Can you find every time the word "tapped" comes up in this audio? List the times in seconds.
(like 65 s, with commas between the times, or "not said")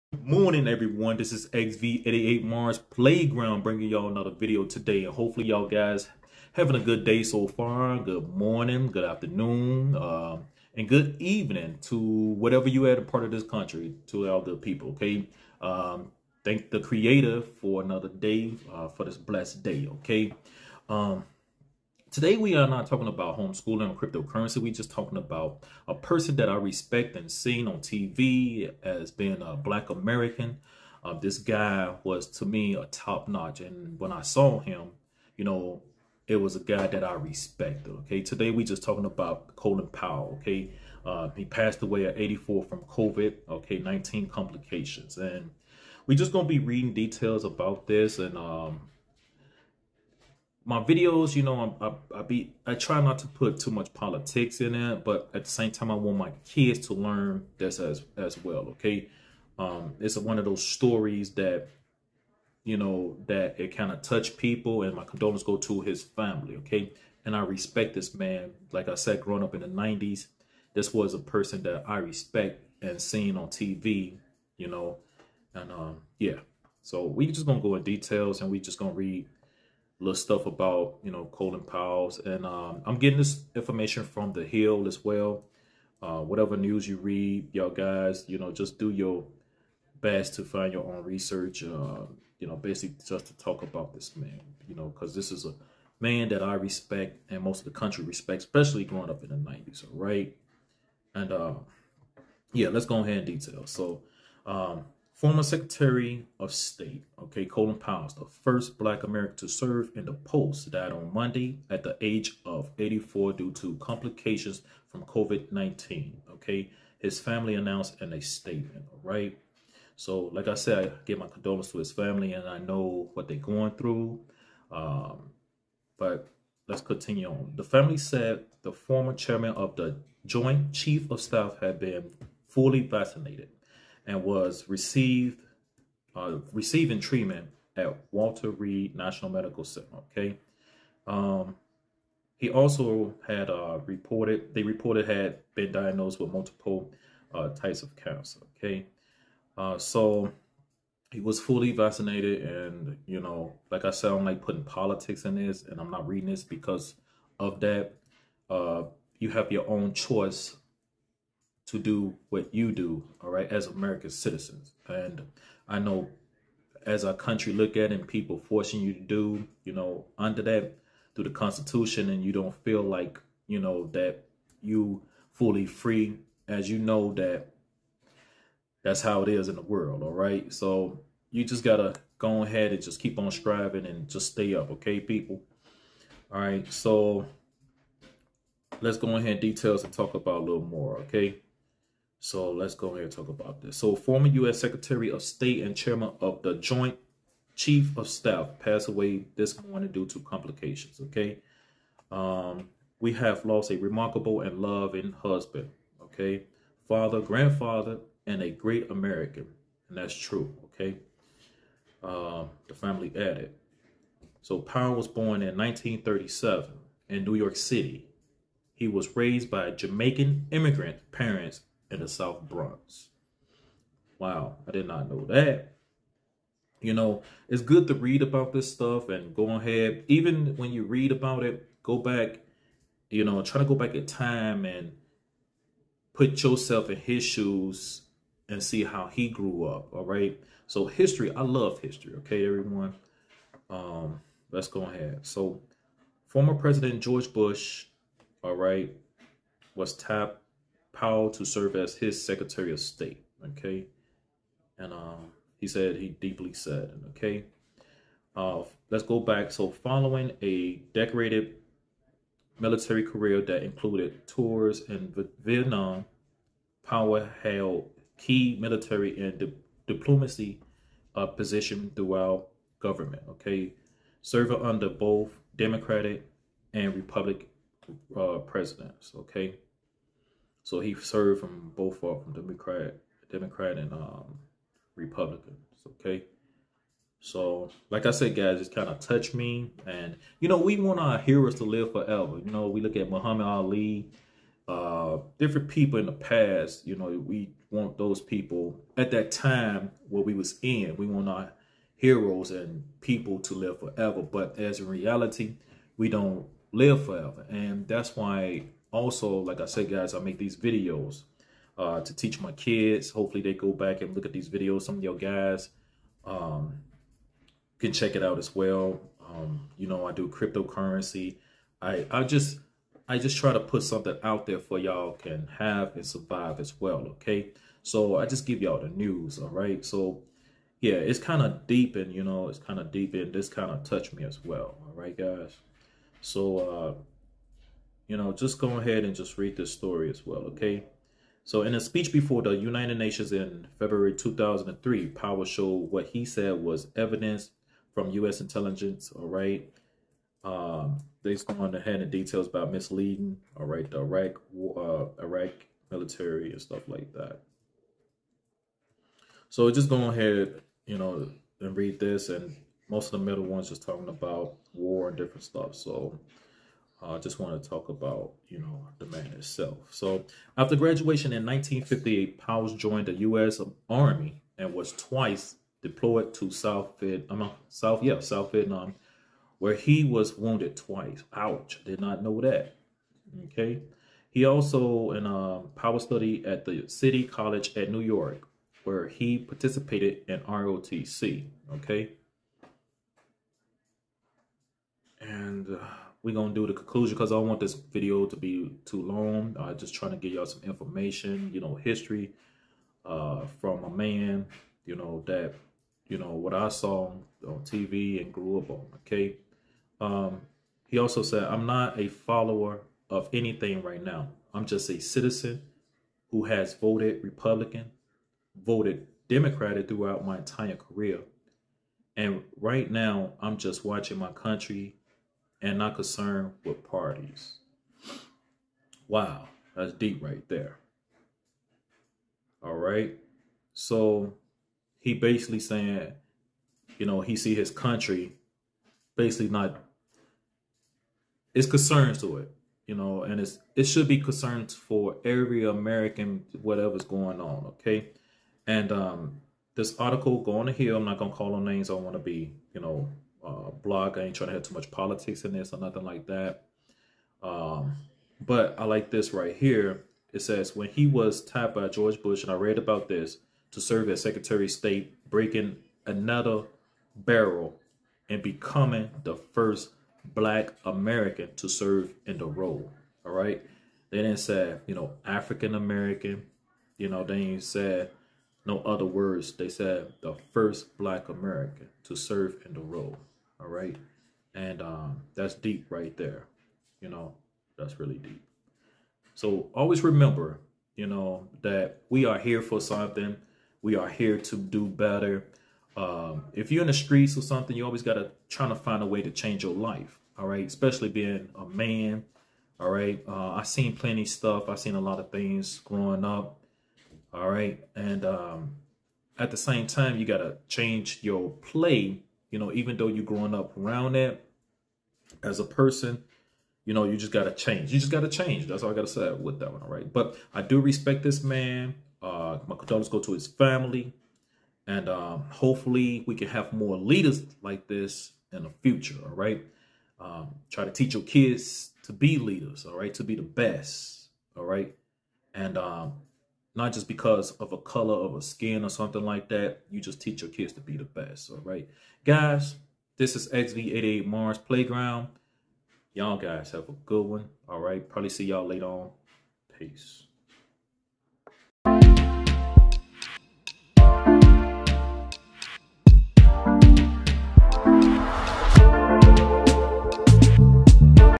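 249 s, 461 s.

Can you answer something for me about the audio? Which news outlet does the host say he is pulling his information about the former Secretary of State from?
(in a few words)
The Hill.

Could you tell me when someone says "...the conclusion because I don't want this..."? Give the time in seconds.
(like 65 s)
396 s.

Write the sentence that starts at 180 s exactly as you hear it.
So you just gotta go ahead and just keep on striving and just stay up, okay, people?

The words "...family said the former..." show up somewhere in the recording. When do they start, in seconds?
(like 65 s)
127 s.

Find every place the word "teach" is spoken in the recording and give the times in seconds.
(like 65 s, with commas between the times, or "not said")
312 s, 530 s, 540 s.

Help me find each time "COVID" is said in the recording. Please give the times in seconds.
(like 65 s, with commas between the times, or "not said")
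42 s, 115 s.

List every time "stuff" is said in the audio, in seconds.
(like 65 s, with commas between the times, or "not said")
80 s, 228 s, 356 s, 365 s, 504 s.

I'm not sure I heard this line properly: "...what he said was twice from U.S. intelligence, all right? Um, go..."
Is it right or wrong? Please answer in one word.
wrong.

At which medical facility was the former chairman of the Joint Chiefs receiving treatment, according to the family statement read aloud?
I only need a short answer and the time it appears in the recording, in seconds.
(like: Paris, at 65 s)
Walter Reed National Medical Center, at 138 s.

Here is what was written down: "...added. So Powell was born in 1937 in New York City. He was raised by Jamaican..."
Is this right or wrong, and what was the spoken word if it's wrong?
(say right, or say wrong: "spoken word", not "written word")
right.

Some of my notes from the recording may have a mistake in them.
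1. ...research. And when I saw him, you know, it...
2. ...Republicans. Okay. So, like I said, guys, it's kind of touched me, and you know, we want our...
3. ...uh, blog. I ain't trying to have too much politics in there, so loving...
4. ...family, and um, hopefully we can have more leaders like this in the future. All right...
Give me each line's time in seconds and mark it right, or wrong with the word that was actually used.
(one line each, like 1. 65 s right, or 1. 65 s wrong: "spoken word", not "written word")
1. 33 s wrong: "notch", not "research"
2. 284 s right
3. 453 s wrong: "nothing", not "loving"
4. 523 s right.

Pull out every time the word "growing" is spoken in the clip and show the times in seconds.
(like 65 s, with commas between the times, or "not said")
69 s, 98 s, 505 s, 513 s.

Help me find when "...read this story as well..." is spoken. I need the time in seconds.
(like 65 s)
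339 s.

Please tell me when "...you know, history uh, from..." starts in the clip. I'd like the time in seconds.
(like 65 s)
401 s.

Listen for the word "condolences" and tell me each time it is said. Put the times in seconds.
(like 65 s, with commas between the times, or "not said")
65 s, 121 s, 522 s.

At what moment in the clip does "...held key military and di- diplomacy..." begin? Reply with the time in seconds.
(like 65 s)
267 s.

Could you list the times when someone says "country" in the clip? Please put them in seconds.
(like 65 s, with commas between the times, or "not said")
13 s, 97 s, 167 s, 424 s, 437 s.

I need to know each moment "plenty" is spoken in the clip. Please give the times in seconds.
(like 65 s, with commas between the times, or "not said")
503 s.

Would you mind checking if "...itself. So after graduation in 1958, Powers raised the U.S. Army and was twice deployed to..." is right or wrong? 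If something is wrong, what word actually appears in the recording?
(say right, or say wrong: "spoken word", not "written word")
wrong: "joined", not "raised".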